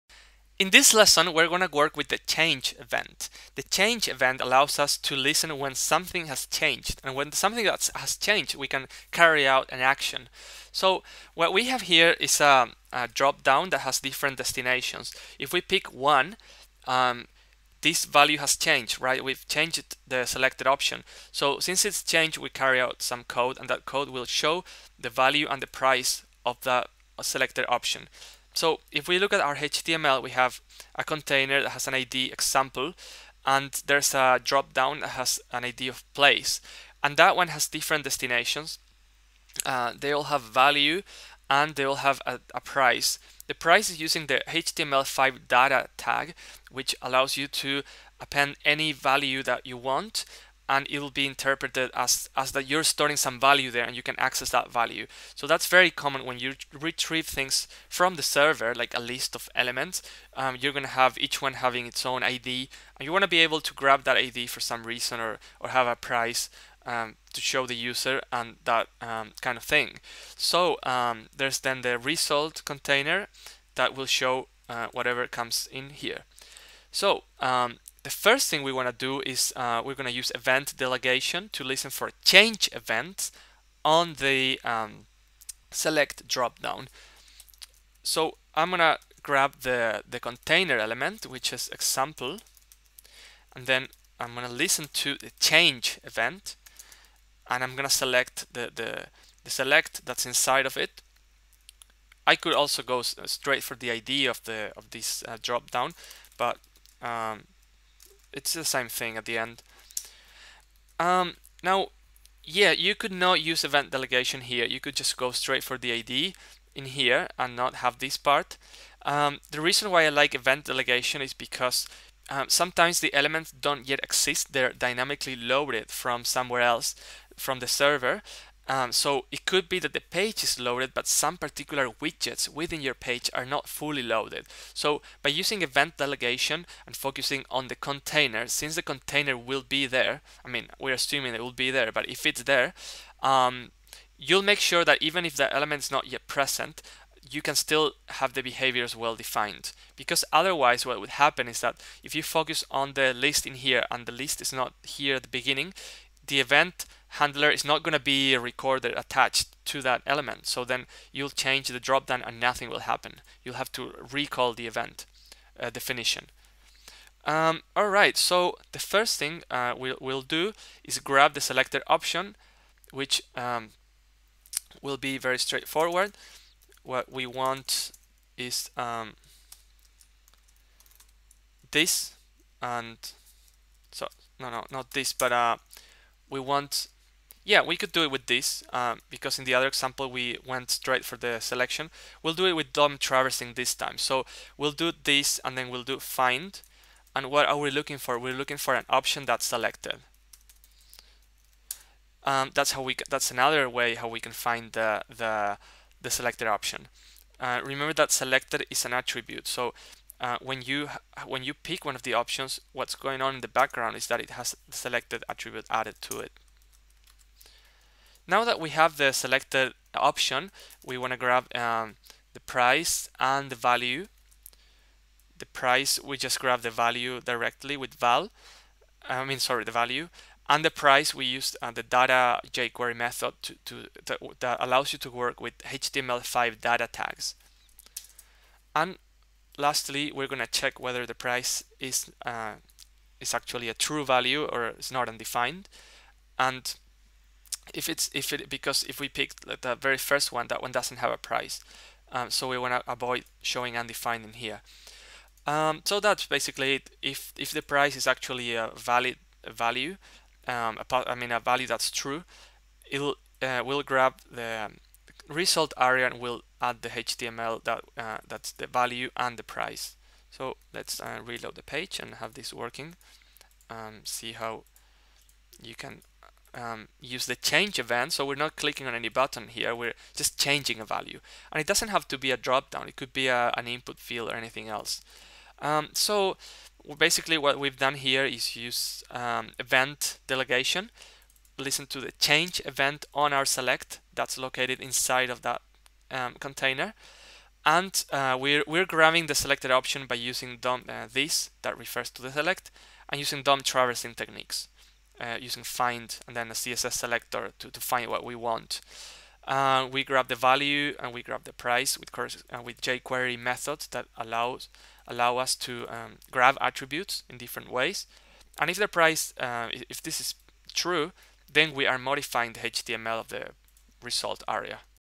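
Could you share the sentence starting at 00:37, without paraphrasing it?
And that one has different destinations.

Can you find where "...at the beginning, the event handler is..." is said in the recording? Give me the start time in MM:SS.
02:35.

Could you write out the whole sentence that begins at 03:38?
Now that we have the selected option, we want to grab um, the price and the value.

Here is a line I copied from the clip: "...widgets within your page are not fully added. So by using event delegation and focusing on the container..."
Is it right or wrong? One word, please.
wrong.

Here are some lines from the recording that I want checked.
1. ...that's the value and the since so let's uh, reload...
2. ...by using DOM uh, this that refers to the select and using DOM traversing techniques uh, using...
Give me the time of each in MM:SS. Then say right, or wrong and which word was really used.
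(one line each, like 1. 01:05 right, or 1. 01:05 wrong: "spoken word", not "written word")
1. 04:28 wrong: "price", not "since"
2. 05:00 right.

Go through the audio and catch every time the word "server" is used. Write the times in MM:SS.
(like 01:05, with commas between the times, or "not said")
00:58, 02:07.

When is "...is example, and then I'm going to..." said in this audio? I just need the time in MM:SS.
01:31.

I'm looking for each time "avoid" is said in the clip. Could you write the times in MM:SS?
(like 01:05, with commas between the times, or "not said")
04:12.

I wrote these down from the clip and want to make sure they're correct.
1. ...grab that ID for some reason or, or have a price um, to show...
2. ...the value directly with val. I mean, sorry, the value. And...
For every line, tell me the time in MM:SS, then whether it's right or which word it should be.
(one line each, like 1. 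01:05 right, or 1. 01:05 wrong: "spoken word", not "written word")
1. 01:03 right
2. 03:46 right.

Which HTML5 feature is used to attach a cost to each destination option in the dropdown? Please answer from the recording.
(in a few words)
data tag.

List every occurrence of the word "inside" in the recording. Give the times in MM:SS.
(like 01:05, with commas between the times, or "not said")
01:40, 04:54.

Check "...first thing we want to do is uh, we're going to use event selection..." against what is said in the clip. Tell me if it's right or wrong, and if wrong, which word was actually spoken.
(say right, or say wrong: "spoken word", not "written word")
wrong: "delegation", not "selection".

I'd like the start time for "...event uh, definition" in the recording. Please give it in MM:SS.
02:44.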